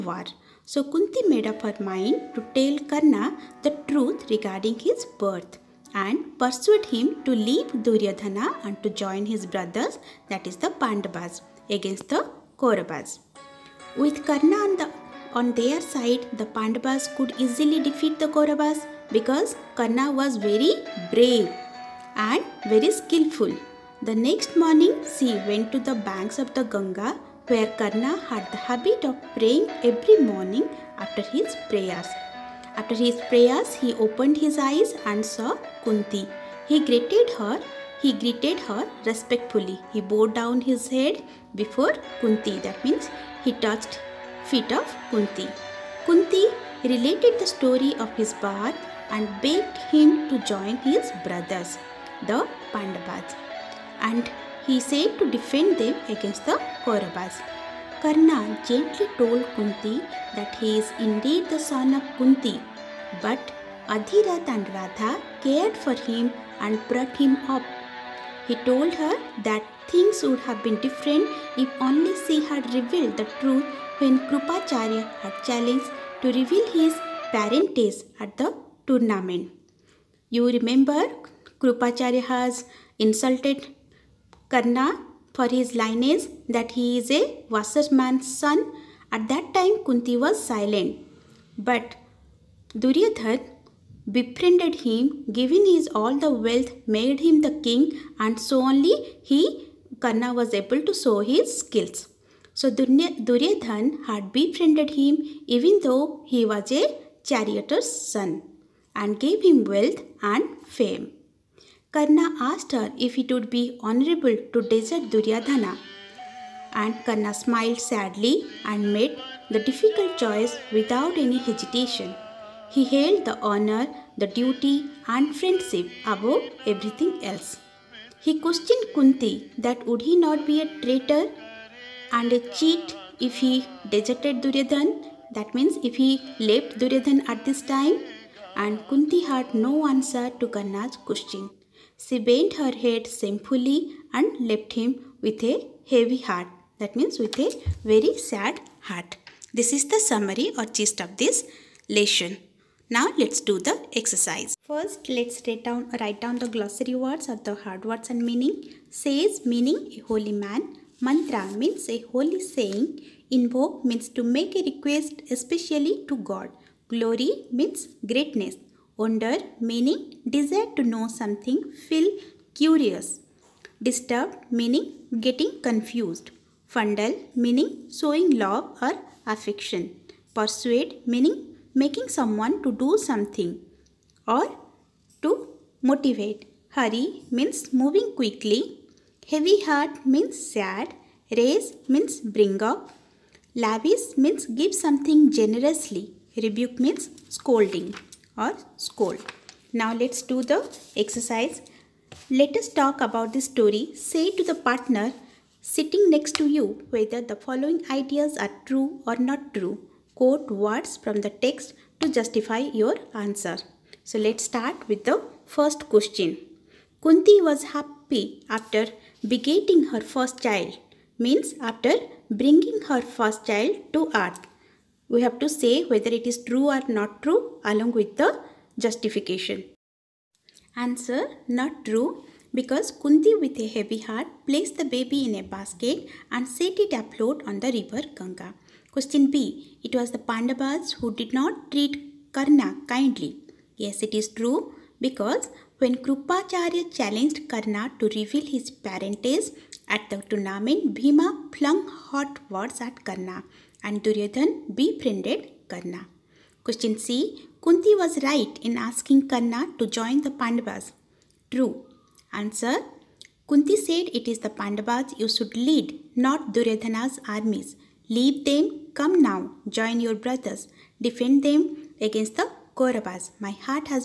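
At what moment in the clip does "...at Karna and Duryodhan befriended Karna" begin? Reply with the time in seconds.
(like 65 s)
252 s.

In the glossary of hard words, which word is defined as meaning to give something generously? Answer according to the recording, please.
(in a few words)
Lavish.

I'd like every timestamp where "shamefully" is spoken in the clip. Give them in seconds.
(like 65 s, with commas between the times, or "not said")
143 s.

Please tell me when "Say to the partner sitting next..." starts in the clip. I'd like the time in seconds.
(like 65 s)
203 s.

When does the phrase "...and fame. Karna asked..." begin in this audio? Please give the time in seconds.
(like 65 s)
110 s.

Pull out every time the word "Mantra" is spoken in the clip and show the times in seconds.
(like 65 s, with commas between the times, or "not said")
161 s.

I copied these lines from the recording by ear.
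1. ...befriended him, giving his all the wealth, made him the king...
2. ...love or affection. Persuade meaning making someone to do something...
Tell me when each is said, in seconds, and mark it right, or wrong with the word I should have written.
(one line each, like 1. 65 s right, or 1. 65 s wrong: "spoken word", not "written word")
1. 94 s right
2. 178 s right.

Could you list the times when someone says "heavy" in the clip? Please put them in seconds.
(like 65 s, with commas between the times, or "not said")
145 s, 189 s, 233 s.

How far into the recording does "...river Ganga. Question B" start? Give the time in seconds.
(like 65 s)
237 s.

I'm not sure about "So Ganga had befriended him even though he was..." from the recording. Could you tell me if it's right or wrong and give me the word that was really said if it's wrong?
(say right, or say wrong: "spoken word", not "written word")
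wrong: "Duryodhan", not "Ganga".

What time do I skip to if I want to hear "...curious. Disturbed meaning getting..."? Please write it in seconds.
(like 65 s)
172 s.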